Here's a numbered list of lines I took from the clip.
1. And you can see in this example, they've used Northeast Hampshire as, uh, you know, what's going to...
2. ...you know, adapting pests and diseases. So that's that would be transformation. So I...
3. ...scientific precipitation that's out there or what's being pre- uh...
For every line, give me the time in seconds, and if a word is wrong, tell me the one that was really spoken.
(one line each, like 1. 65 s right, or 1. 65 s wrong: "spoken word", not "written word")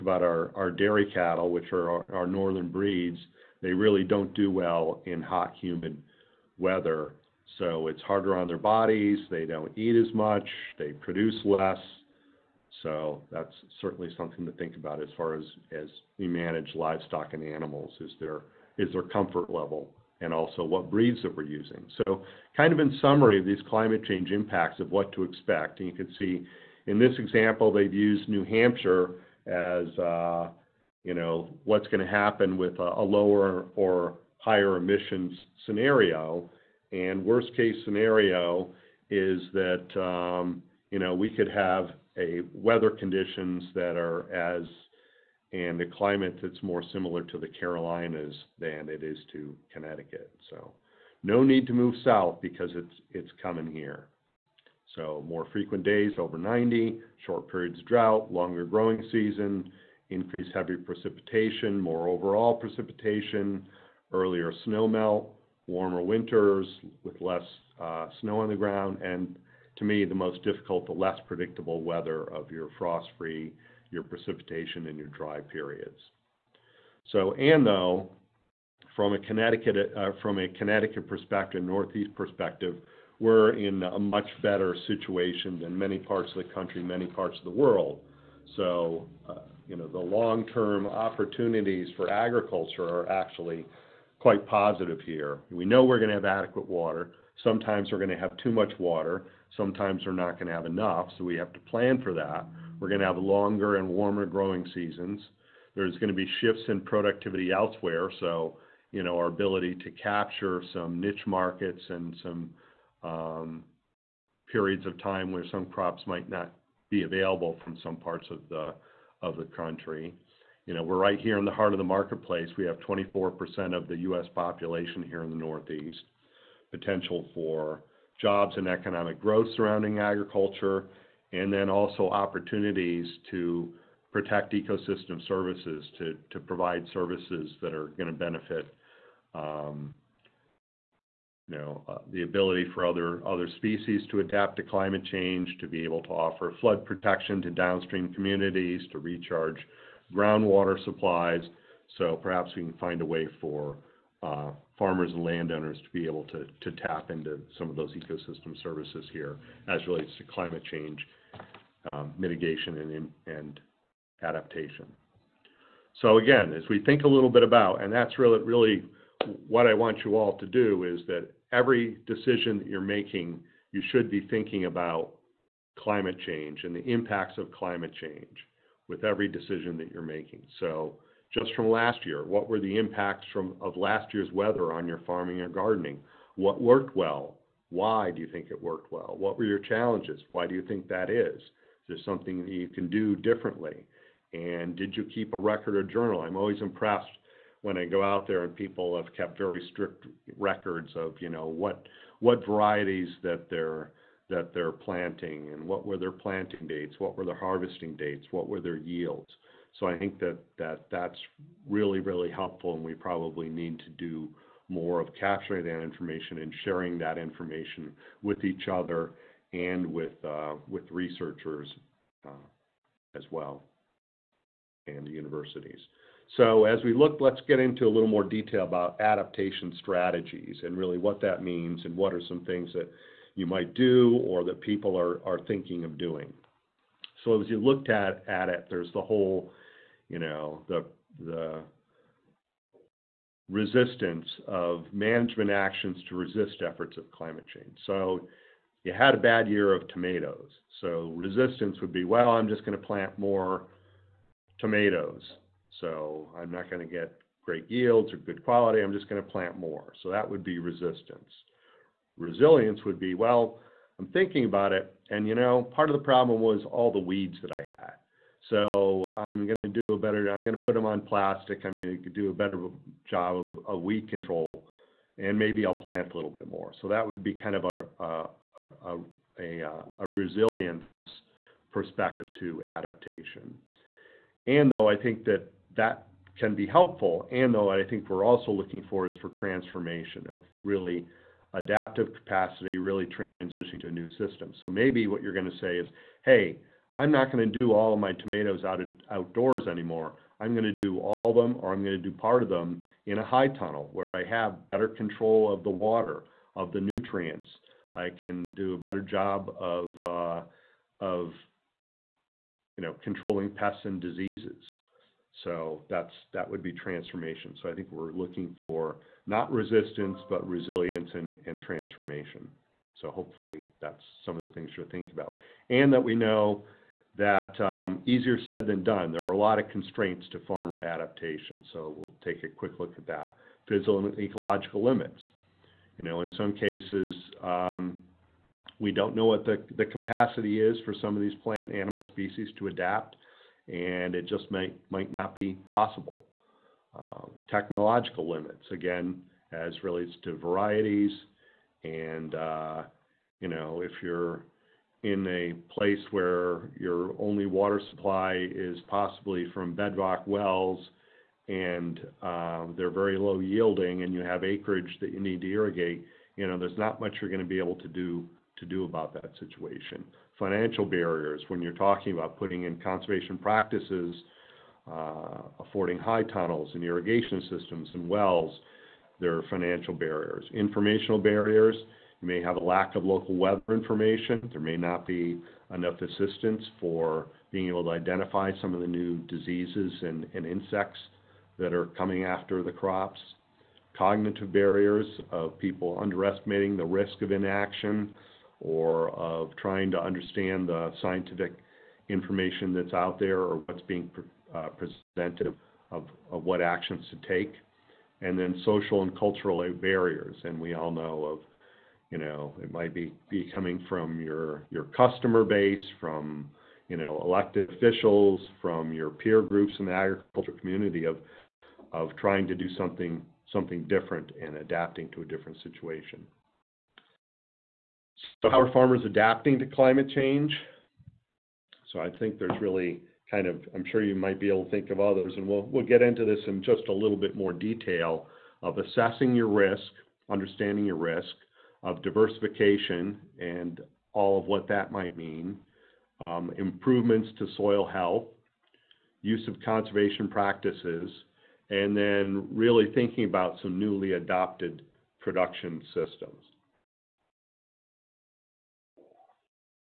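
1. 25 s wrong: "New", not "Northeast"
2. 312 s wrong: "controlling", not "adapting"
3. 401 s wrong: "information", not "precipitation".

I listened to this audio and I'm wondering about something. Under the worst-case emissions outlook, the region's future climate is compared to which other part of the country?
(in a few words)
the Carolinas.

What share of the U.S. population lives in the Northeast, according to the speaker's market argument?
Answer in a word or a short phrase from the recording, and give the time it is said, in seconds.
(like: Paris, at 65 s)
24%, at 122 s.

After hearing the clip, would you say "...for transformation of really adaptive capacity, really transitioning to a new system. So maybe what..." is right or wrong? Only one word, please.
right.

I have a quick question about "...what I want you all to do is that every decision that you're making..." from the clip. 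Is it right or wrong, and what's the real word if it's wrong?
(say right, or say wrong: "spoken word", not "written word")
right.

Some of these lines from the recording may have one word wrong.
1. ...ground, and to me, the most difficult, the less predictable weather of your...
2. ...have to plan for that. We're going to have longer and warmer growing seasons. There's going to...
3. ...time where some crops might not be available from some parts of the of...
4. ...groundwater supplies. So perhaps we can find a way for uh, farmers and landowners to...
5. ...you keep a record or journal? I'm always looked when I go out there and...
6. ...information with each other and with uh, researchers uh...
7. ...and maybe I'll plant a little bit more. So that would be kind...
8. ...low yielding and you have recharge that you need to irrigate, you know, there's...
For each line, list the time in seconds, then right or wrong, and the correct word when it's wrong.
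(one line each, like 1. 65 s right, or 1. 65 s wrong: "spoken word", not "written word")
1. 68 s right
2. 101 s right
3. 115 s right
4. 150 s right
5. 194 s wrong: "impressed", not "looked"
6. 217 s right
7. 275 s right
8. 363 s wrong: "acreage", not "recharge".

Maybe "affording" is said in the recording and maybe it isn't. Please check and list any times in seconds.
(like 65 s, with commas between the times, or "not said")
375 s.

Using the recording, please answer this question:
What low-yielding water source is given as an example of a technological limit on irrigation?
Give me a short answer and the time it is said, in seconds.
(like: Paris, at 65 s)
bedrock wells, at 359 s.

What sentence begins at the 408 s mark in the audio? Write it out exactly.
And then social and cultural barriers.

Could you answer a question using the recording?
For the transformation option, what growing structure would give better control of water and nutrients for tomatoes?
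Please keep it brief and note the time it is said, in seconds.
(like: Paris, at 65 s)
a high tunnel, at 303 s.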